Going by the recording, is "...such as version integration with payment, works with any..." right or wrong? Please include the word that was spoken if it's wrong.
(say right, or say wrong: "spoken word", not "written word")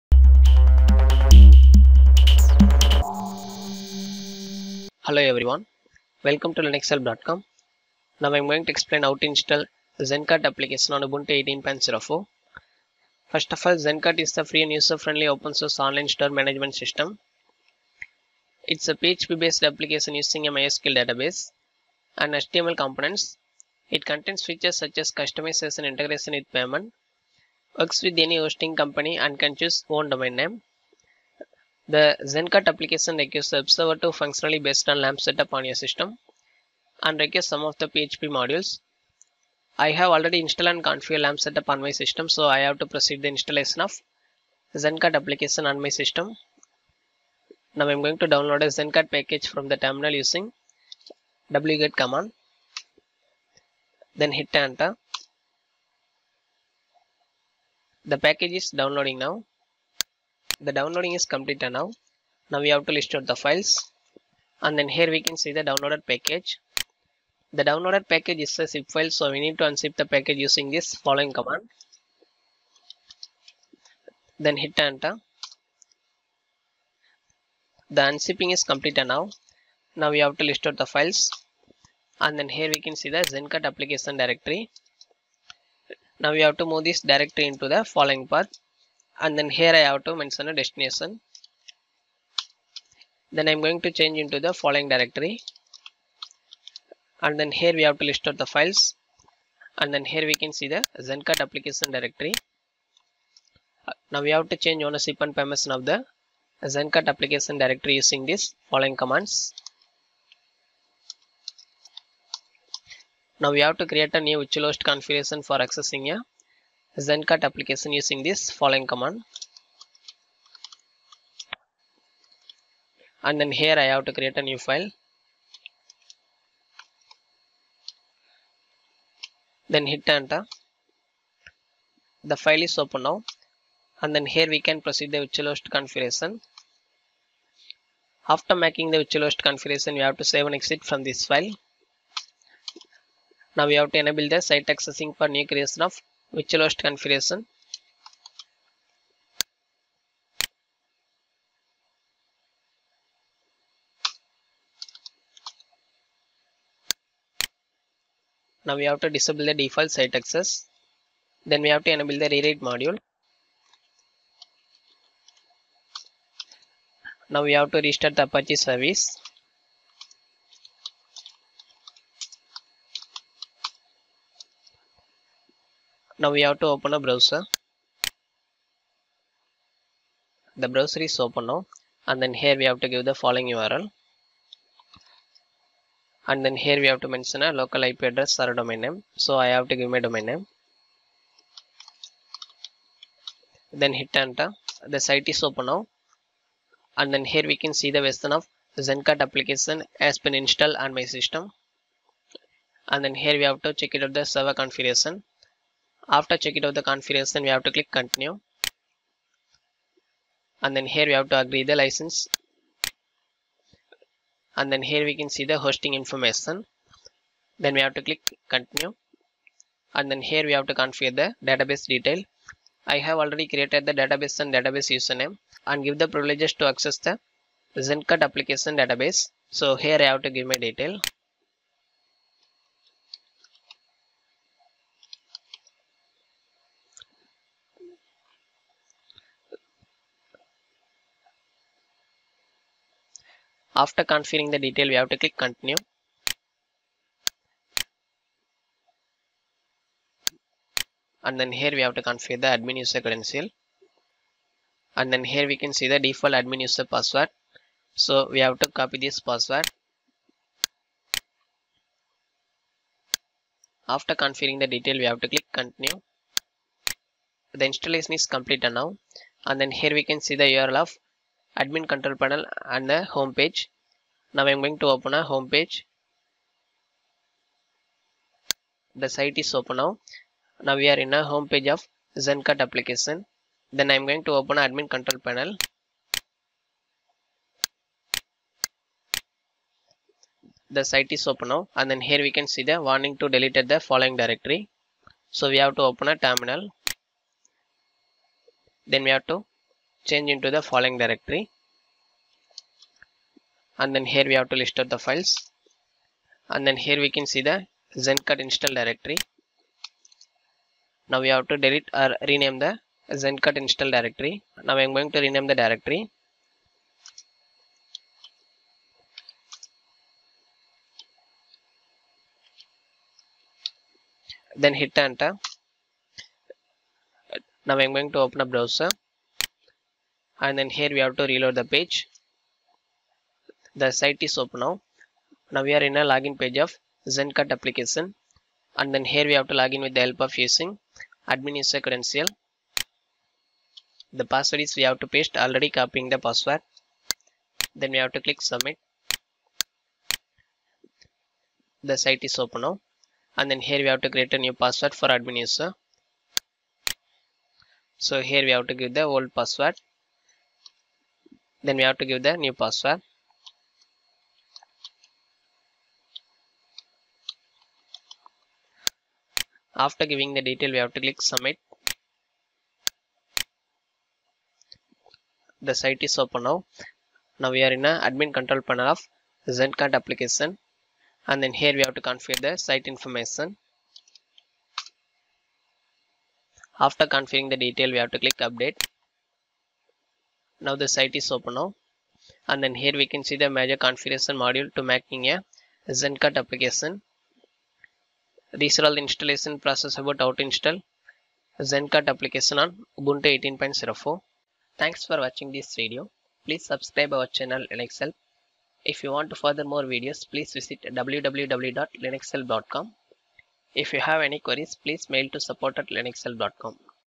wrong: "customization", not "version".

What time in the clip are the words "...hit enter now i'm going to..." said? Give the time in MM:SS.
05:24.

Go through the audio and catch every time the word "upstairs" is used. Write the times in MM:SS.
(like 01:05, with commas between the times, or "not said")
not said.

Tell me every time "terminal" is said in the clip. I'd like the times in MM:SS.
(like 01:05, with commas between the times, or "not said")
00:49, 04:56.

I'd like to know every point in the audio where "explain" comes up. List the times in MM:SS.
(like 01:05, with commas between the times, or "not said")
00:08.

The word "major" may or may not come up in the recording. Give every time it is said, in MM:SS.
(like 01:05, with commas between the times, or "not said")
06:33.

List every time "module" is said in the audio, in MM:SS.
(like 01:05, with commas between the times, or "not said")
00:38, 02:42, 06:34.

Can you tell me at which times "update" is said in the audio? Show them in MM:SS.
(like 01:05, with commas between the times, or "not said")
06:28.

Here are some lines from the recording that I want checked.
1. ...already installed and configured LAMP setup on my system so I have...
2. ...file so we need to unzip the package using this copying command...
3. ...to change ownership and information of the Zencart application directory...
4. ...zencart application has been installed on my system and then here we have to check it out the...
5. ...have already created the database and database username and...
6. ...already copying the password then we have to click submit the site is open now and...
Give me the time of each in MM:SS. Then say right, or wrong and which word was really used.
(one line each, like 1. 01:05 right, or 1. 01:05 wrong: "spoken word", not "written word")
1. 00:40 right
2. 01:08 wrong: "following", not "copying"
3. 01:44 wrong: "permission", not "information"
4. 03:18 right
5. 03:43 right
6. 05:45 right.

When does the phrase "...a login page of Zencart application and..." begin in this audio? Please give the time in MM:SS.
05:36.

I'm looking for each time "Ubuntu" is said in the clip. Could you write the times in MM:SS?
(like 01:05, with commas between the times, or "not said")
00:11, 06:42.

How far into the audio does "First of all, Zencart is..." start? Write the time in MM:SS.
00:13.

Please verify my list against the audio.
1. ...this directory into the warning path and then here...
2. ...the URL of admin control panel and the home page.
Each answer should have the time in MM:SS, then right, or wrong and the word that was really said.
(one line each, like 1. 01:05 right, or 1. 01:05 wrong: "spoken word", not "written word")
1. 01:26 wrong: "following", not "warning"
2. 04:30 right.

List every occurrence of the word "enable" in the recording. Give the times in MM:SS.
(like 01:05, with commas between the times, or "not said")
02:24, 02:41.